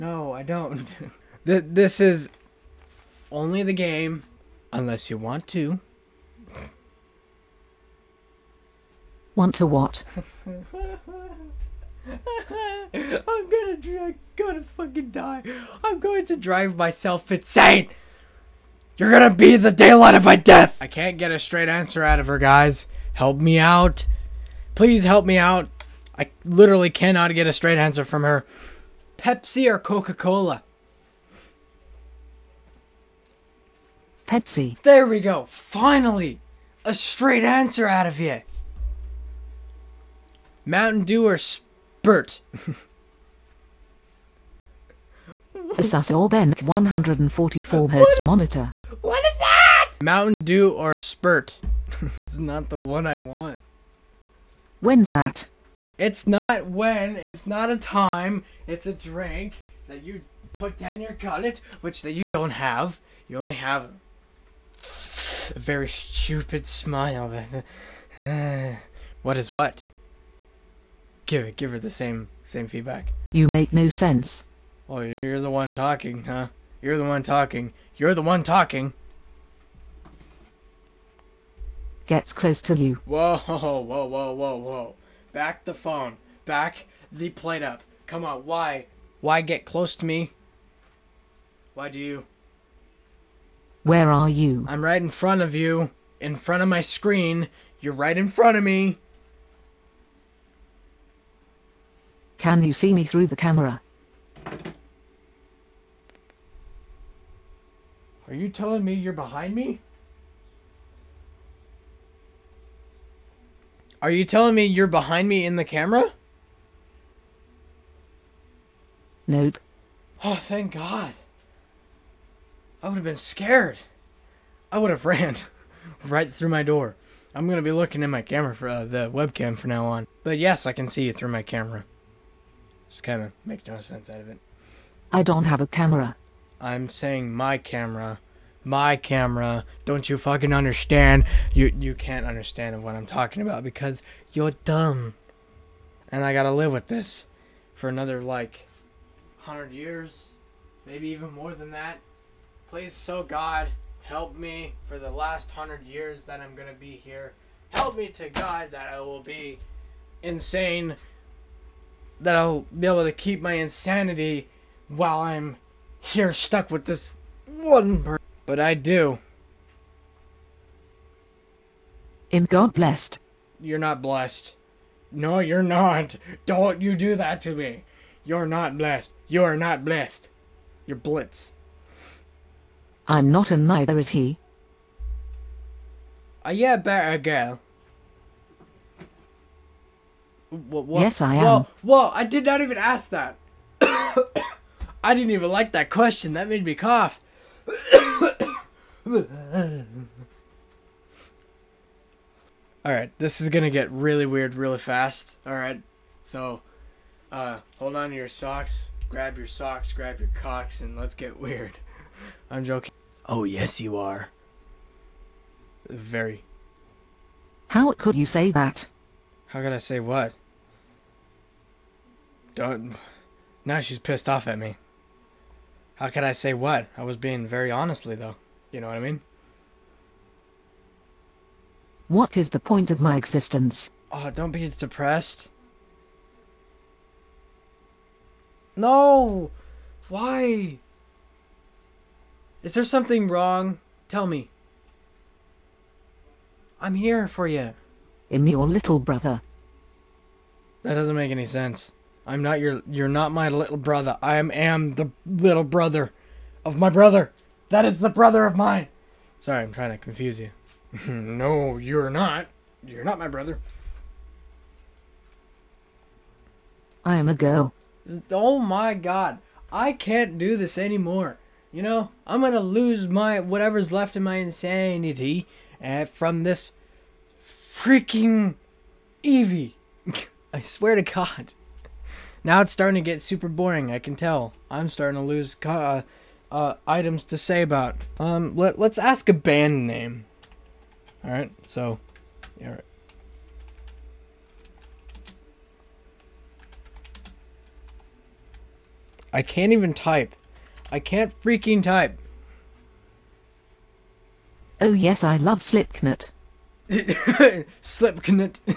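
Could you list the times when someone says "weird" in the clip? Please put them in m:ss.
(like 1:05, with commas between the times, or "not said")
3:24, 3:31.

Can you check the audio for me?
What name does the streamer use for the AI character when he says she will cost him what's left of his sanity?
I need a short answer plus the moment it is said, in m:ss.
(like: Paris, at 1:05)
Evie, at 4:39.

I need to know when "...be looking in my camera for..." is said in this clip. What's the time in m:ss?
2:07.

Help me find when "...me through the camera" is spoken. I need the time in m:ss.
1:42.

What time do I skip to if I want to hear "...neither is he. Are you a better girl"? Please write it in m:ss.
3:03.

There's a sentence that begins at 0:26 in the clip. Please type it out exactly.
I literally cannot get a straight answer from her.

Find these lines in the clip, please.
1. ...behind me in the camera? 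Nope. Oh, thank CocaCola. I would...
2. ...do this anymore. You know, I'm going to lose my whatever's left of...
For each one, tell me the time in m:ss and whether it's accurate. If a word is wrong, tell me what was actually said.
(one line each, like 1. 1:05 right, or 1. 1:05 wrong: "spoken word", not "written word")
1. 1:54 wrong: "God", not "CocaCola"
2. 4:30 right.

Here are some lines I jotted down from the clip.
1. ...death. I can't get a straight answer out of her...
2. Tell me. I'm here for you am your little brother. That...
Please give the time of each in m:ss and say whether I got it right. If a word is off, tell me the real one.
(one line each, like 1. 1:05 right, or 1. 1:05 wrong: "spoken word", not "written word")
1. 0:20 right
2. 4:04 right.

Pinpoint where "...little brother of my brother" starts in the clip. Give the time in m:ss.
4:15.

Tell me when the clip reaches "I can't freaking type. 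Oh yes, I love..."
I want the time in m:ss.
5:00.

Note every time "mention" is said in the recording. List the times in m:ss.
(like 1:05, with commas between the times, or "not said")
not said.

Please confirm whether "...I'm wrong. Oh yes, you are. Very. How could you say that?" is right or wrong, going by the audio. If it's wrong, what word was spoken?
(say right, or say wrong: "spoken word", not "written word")
wrong: "joking", not "wrong".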